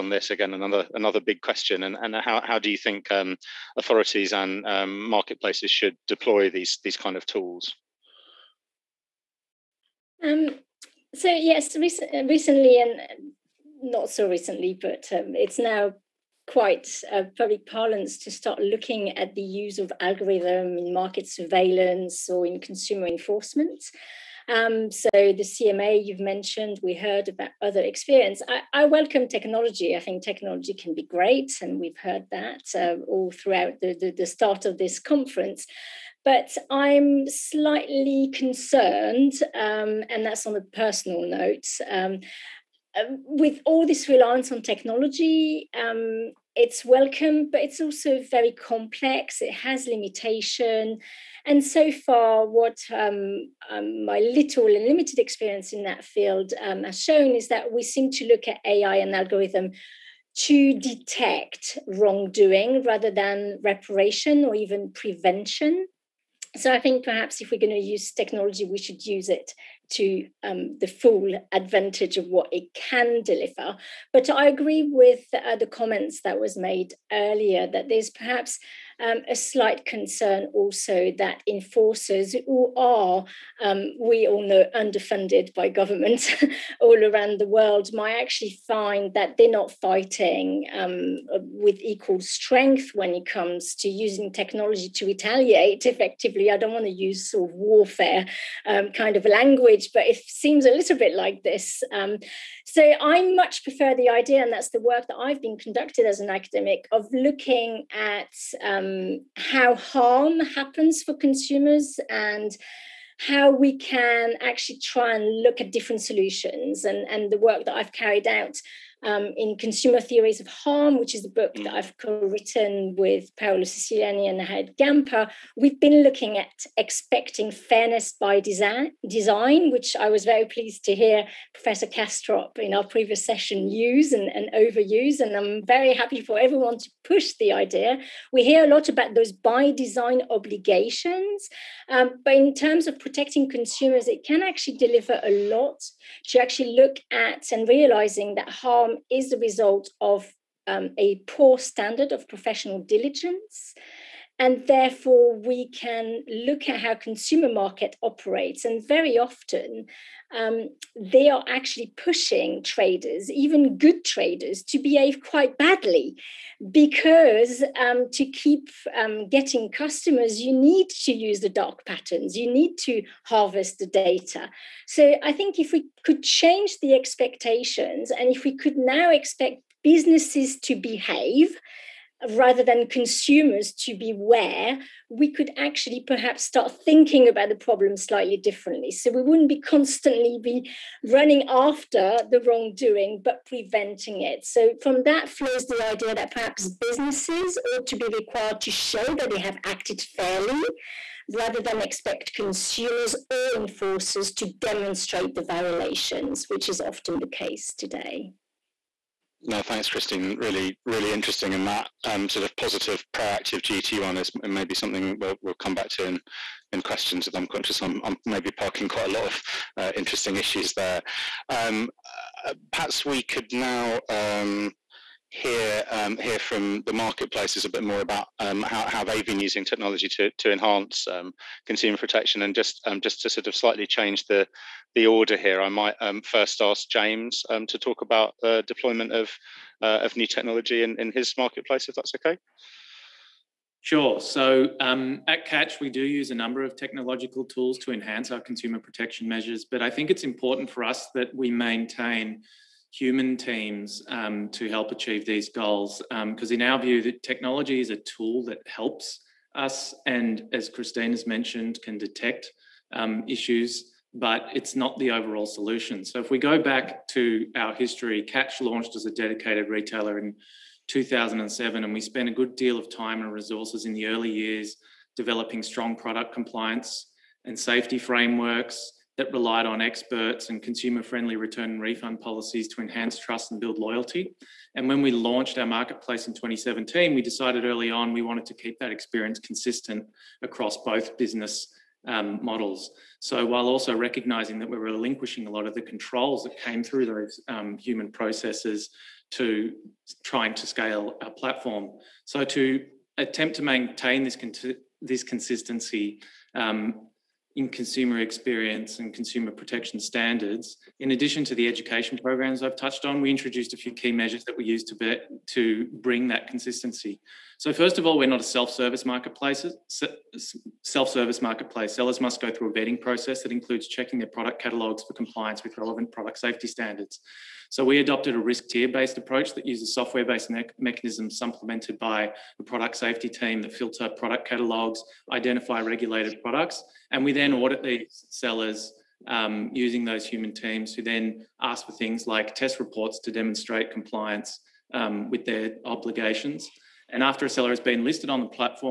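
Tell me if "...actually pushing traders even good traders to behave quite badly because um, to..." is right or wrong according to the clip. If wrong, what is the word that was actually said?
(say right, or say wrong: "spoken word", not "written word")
right.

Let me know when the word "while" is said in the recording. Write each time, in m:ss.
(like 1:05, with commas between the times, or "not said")
4:53.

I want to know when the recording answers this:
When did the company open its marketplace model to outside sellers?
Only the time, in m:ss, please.
4:46.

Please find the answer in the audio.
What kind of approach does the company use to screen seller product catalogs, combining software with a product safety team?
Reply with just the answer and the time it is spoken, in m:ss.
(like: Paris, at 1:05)
risk tier-based approach, at 5:28.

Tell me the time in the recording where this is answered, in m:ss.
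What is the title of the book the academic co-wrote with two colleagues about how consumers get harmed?
1:59.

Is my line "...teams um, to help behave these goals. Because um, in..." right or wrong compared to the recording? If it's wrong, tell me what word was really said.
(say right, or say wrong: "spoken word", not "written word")
wrong: "achieve", not "behave".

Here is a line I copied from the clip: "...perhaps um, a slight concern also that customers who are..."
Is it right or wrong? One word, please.
wrong.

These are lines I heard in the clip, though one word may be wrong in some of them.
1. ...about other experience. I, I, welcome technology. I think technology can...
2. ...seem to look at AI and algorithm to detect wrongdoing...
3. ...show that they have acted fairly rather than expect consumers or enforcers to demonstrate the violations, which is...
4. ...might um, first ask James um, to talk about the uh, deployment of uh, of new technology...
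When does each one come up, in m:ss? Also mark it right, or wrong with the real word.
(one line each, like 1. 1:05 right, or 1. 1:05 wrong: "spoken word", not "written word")
1. 0:27 right
2. 0:57 right
3. 3:18 right
4. 3:55 right.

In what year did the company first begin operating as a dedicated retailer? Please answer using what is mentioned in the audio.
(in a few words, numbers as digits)
2007.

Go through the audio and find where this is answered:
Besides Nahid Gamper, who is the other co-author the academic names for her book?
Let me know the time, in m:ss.
2:03.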